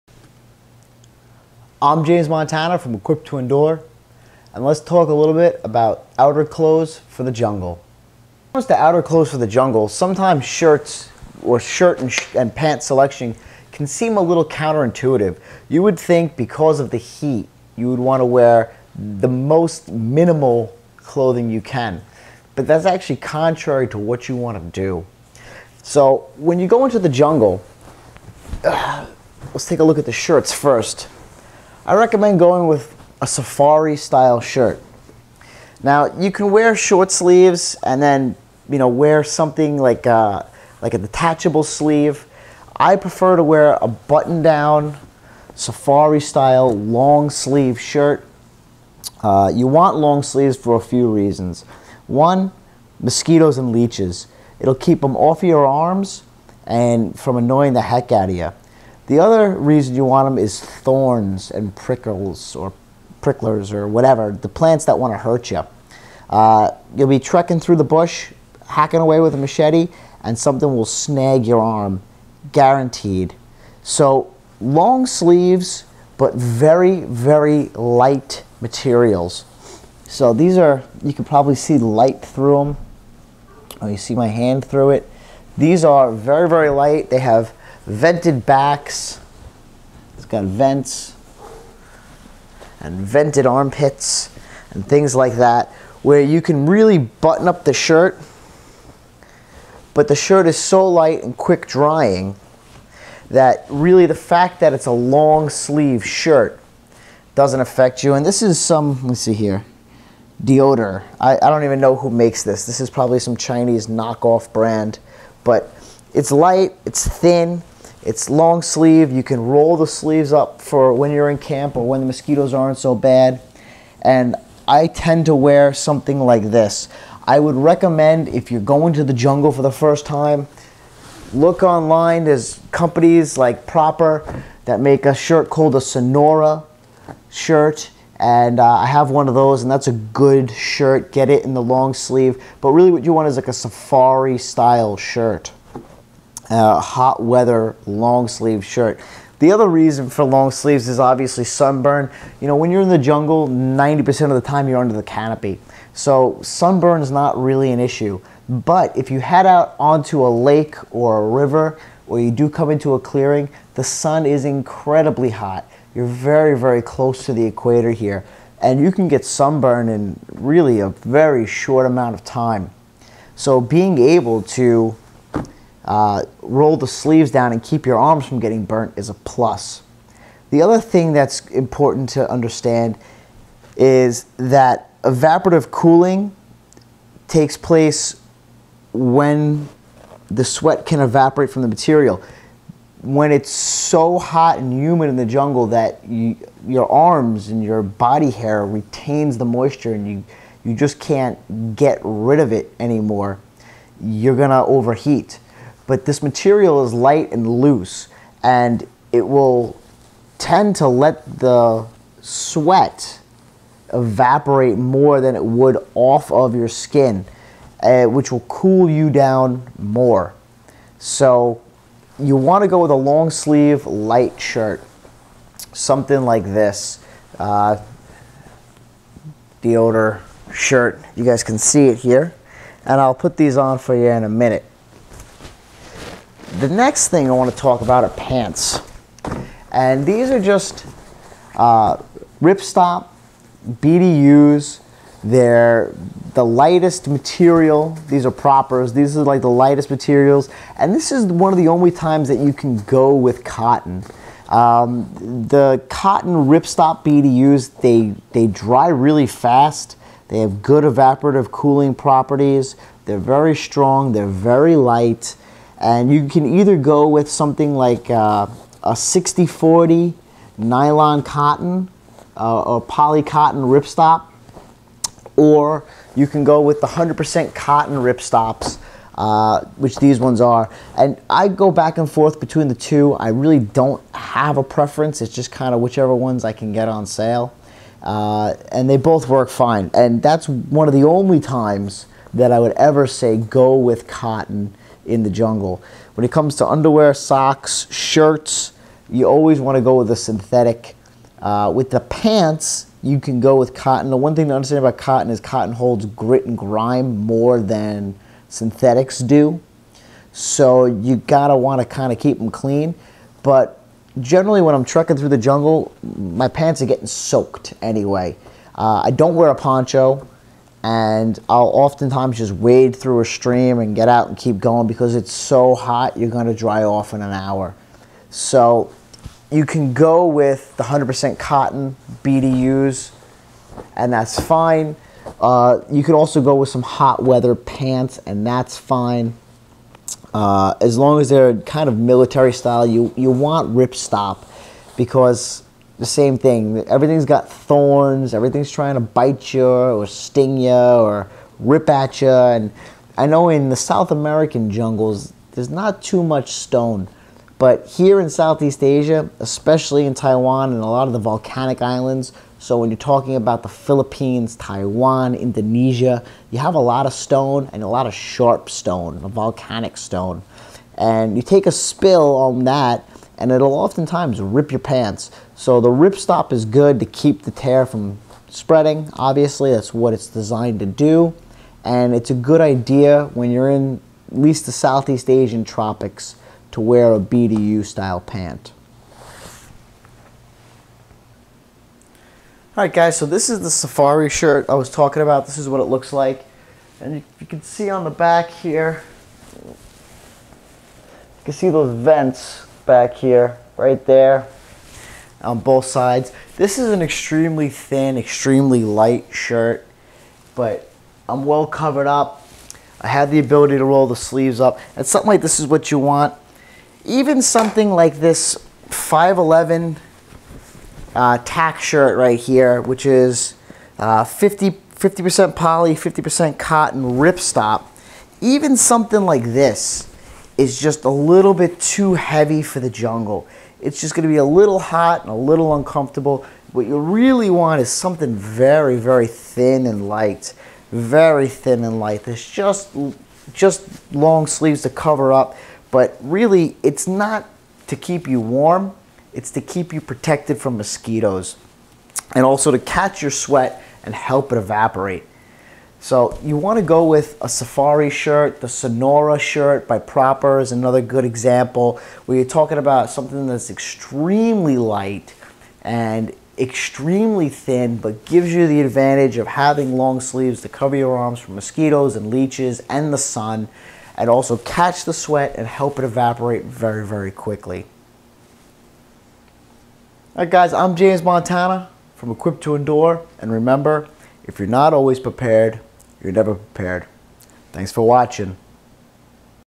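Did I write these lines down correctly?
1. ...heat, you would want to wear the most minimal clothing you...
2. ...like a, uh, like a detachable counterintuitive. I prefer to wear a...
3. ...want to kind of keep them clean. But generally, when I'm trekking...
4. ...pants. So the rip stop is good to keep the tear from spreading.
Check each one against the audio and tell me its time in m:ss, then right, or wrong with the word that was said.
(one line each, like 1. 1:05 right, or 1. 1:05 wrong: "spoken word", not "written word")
1. 0:16 right
2. 0:39 wrong: "sleeve", not "counterintuitive"
3. 5:11 right
4. 6:14 right.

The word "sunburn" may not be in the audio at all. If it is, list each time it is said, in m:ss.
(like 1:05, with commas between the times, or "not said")
2:31, 2:36, 2:49.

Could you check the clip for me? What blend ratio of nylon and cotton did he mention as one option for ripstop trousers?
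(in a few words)
60-40.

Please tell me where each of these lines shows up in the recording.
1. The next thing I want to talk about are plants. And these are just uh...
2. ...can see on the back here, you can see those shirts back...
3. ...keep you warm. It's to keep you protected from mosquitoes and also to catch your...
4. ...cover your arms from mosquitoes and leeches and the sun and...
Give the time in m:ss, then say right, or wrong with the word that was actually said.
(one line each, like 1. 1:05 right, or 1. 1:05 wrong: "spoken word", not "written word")
1. 3:56 wrong: "pants", not "plants"
2. 6:37 wrong: "vents", not "shirts"
3. 7:27 right
4. 7:50 right.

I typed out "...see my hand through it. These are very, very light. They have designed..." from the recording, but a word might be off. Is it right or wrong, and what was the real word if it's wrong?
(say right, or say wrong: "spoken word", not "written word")
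wrong: "vented", not "designed".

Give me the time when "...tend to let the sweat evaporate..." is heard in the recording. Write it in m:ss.
3:30.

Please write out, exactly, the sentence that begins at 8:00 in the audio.
All right, guys, I'm James Montana from Equipped to Endure.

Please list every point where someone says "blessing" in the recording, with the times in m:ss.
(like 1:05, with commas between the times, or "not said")
not said.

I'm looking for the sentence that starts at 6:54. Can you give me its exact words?
And something like this is what you want.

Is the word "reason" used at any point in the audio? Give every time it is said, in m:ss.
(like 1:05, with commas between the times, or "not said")
0:51, 0:59, 2:29.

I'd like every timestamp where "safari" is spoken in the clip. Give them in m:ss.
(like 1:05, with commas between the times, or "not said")
0:33, 0:45, 2:23, 6:33, 7:37.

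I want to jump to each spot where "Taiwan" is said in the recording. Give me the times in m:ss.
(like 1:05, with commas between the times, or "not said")
6:00, 6:04.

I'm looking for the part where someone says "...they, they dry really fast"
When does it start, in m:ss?
4:17.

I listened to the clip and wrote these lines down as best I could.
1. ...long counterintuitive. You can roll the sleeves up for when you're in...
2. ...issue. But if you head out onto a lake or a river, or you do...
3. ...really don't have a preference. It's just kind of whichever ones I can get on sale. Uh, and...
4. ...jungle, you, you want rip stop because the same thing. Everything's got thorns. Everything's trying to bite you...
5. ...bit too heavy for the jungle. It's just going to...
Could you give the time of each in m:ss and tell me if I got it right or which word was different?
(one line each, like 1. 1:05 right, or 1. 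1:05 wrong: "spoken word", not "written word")
1. 1:58 wrong: "sleeve", not "counterintuitive"
2. 2:37 right
3. 4:43 right
4. 5:42 wrong: "style", not "jungle"
5. 7:11 right.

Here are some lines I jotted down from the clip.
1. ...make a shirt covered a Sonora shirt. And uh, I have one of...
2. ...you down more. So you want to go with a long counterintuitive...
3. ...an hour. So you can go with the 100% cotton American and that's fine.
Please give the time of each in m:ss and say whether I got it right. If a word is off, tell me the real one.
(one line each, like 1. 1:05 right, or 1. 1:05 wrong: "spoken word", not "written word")
1. 2:14 wrong: "called", not "covered"
2. 3:38 wrong: "sleeve", not "counterintuitive"
3. 5:27 wrong: "BDUs", not "American".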